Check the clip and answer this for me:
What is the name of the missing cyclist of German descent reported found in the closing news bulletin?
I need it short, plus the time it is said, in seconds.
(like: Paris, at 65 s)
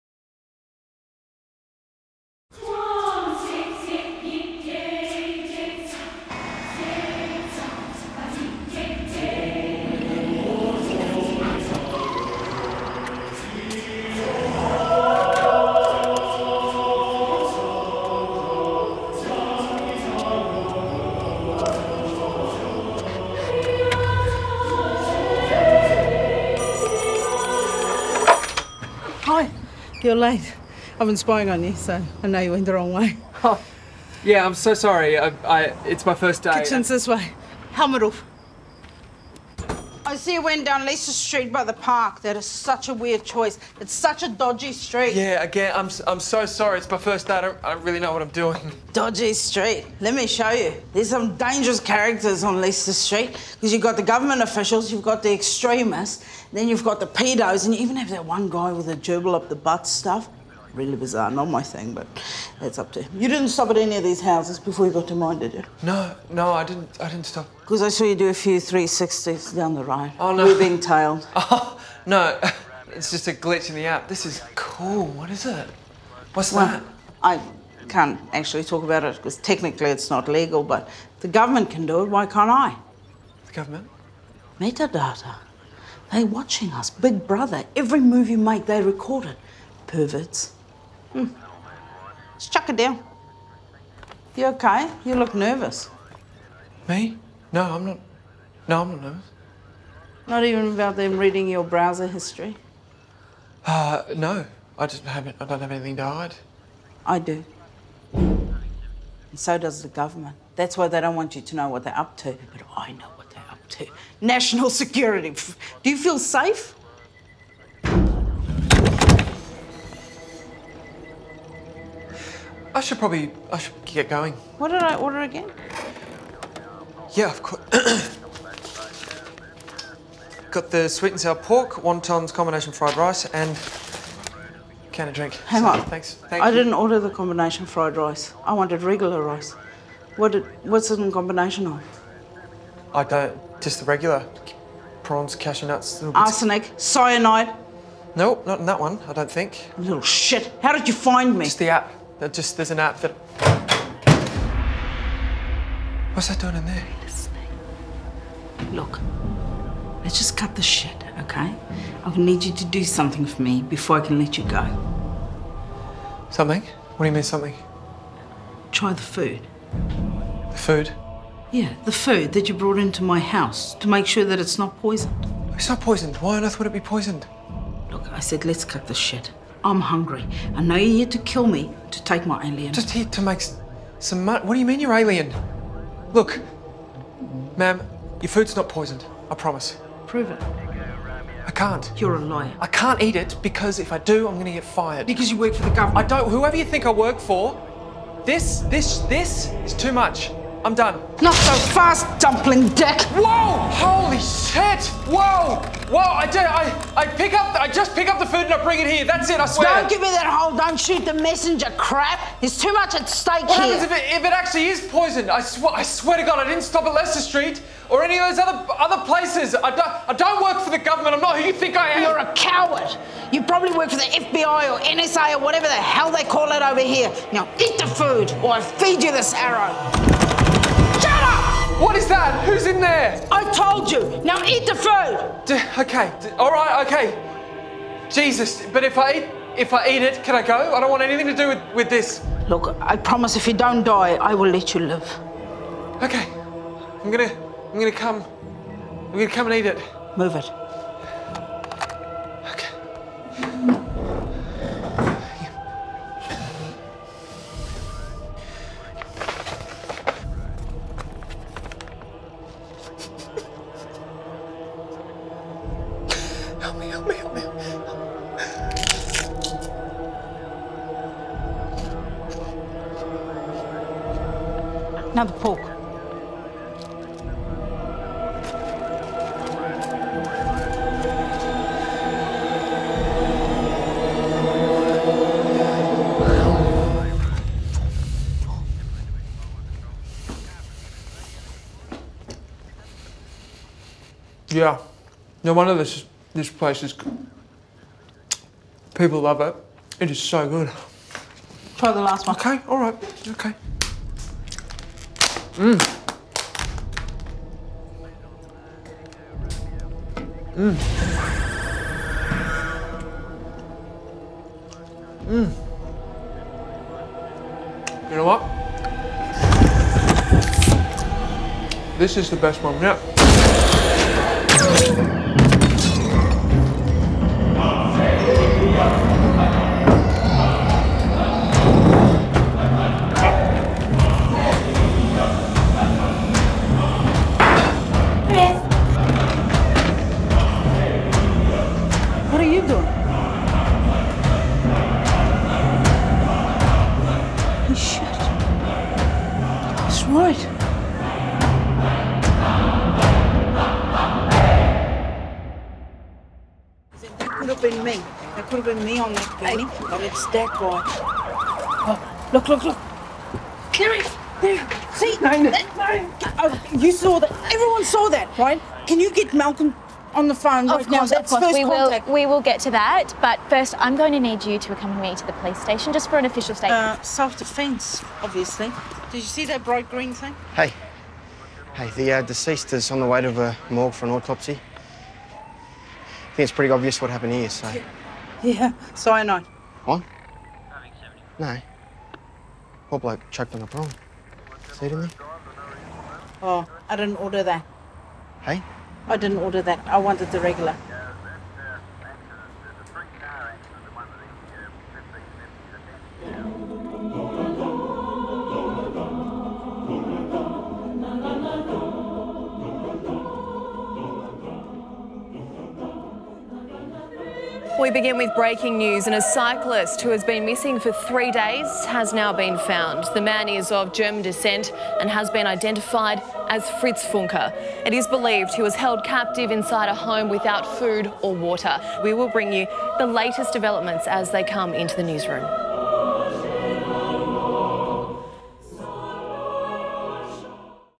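Fritz Funke, at 426 s.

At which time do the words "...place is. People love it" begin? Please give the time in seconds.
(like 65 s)
296 s.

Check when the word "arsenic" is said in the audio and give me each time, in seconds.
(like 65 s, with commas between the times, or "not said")
146 s.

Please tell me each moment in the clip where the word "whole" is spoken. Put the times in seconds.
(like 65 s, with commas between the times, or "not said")
210 s.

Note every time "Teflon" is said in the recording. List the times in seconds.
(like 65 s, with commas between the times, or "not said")
not said.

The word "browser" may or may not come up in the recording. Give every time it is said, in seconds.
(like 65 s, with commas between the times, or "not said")
101 s.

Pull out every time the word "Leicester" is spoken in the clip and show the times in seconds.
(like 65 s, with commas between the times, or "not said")
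40 s, 52 s, 216 s.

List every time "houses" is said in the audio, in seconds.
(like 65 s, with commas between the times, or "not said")
64 s, 173 s.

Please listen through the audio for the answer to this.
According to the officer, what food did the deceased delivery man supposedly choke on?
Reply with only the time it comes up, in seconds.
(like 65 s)
393 s.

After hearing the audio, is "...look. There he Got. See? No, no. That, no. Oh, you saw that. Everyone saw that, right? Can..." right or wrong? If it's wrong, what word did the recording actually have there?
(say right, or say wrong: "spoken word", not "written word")
wrong: "There", not "Got".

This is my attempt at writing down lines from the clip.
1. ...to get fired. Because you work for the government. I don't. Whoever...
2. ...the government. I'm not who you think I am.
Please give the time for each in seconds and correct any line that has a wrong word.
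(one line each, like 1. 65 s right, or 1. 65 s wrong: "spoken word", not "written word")
1. 194 s right
2. 220 s right.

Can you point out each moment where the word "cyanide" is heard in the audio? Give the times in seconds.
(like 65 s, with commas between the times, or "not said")
146 s, 388 s.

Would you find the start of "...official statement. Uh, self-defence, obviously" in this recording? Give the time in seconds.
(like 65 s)
376 s.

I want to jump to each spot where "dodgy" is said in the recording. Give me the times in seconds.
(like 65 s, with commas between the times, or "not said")
44 s, 48 s.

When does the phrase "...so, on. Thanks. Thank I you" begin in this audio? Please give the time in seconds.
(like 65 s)
135 s.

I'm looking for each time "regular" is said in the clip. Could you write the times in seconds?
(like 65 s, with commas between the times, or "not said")
138 s, 143 s, 400 s.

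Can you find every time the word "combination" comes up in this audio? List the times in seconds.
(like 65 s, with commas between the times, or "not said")
132 s, 137 s, 141 s.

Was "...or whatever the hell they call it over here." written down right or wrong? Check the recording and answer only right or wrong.
right.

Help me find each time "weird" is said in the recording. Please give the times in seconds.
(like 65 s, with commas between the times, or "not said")
42 s.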